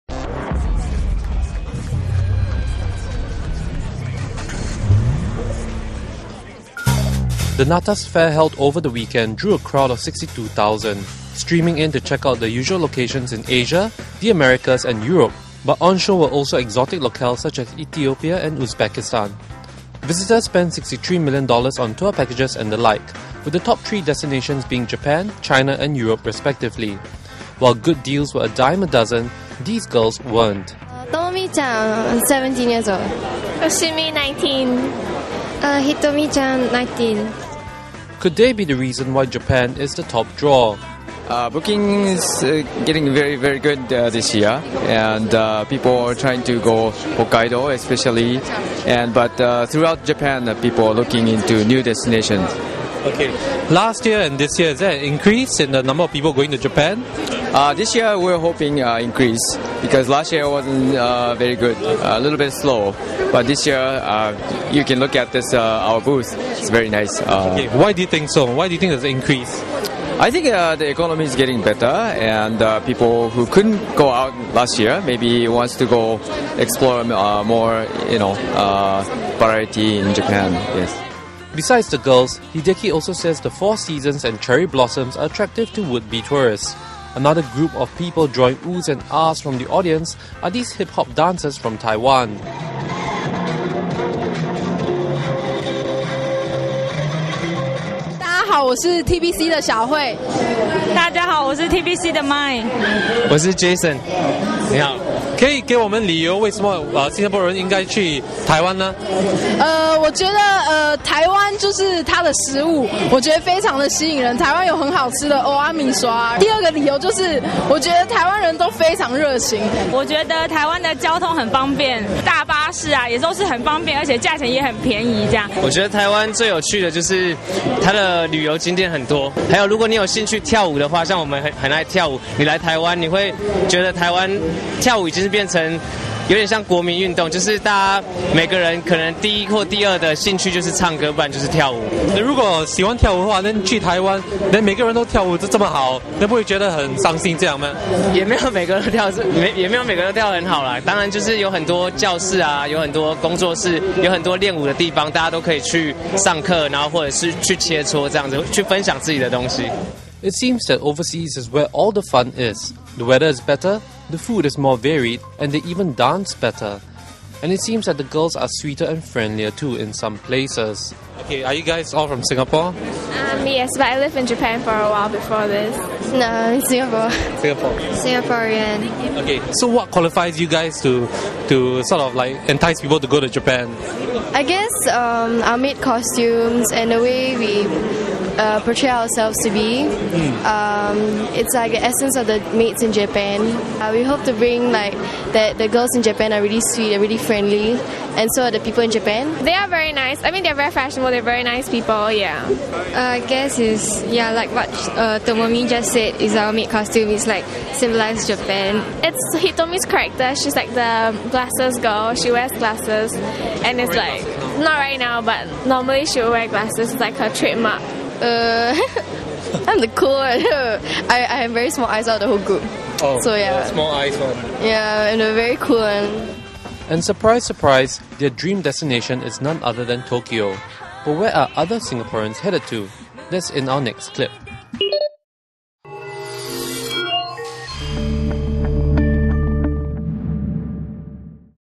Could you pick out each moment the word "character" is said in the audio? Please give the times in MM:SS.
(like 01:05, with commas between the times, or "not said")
03:29.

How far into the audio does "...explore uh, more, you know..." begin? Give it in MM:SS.
01:16.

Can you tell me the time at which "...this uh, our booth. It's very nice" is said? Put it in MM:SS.
01:05.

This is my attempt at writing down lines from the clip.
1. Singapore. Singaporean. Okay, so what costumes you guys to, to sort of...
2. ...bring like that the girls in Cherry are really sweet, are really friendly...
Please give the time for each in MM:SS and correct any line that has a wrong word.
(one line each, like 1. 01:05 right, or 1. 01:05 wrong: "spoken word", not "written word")
1. 02:57 wrong: "qualifies", not "costumes"
2. 03:14 wrong: "Japan", not "Cherry".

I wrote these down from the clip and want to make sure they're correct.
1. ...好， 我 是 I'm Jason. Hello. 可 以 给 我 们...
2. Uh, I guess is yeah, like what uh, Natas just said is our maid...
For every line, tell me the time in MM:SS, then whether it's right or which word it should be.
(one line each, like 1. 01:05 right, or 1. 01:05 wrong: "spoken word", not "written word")
1. 01:41 right
2. 03:22 wrong: "Tomomi", not "Natas".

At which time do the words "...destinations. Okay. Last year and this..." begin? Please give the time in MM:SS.
00:51.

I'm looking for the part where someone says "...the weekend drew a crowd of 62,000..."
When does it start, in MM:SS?
00:08.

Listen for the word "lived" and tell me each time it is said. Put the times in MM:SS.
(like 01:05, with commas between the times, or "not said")
02:53.